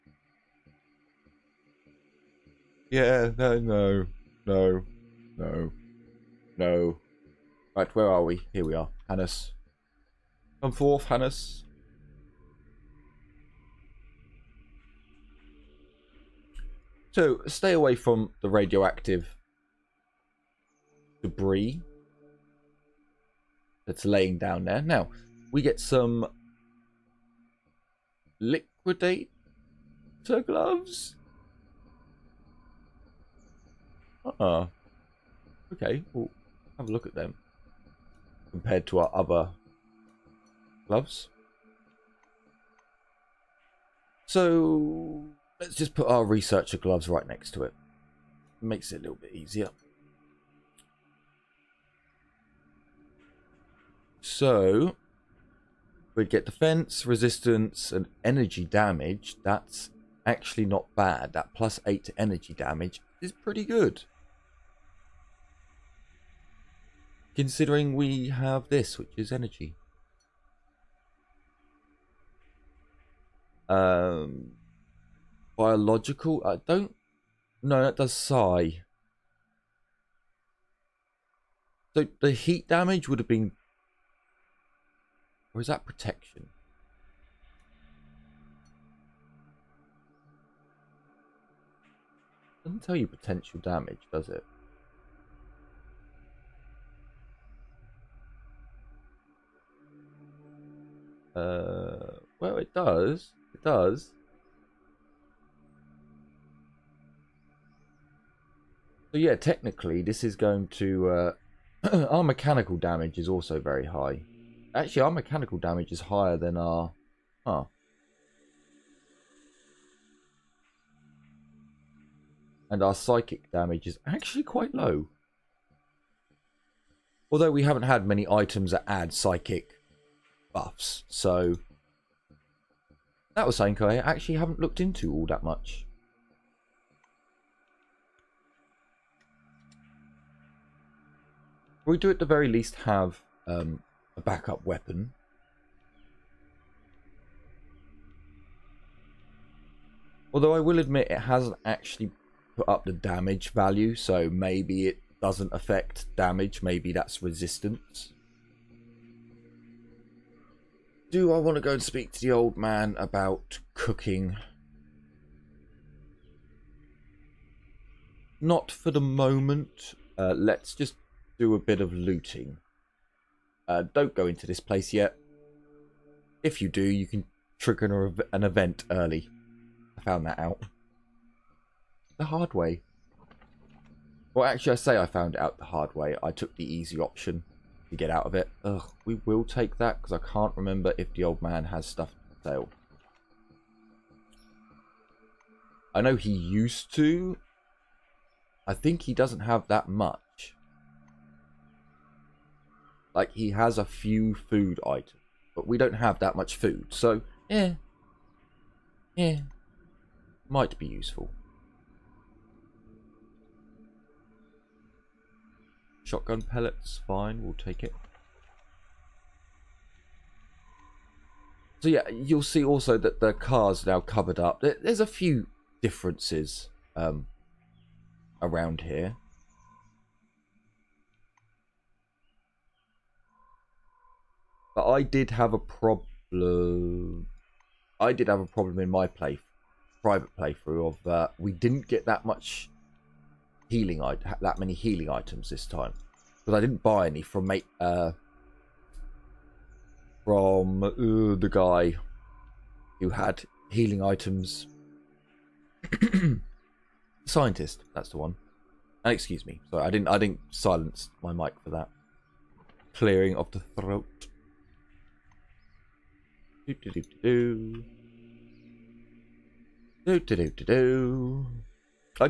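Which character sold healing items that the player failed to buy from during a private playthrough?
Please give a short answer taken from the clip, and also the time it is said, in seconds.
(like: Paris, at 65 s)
Scientist, at 257 s.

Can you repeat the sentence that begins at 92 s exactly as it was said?
Doesn't tell you potential damage, does it?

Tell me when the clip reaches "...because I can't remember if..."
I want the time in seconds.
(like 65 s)
190 s.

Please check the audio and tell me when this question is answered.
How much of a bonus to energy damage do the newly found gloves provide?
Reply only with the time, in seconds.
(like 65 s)
61 s.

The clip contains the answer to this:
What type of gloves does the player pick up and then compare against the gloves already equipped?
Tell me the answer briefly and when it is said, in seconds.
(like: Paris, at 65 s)
Liquidator gloves, at 28 s.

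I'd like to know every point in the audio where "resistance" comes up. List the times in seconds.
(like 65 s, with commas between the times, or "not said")
57 s, 157 s.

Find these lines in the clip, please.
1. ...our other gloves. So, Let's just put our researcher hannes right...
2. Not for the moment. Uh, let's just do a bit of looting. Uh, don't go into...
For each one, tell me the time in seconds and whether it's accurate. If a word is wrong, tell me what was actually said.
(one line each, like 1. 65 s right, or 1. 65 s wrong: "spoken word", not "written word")
1. 39 s wrong: "gloves", not "hannes"
2. 168 s right.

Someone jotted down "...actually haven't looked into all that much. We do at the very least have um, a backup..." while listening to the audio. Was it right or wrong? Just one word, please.
right.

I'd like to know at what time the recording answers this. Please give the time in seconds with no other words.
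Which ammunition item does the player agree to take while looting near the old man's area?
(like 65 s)
216 s.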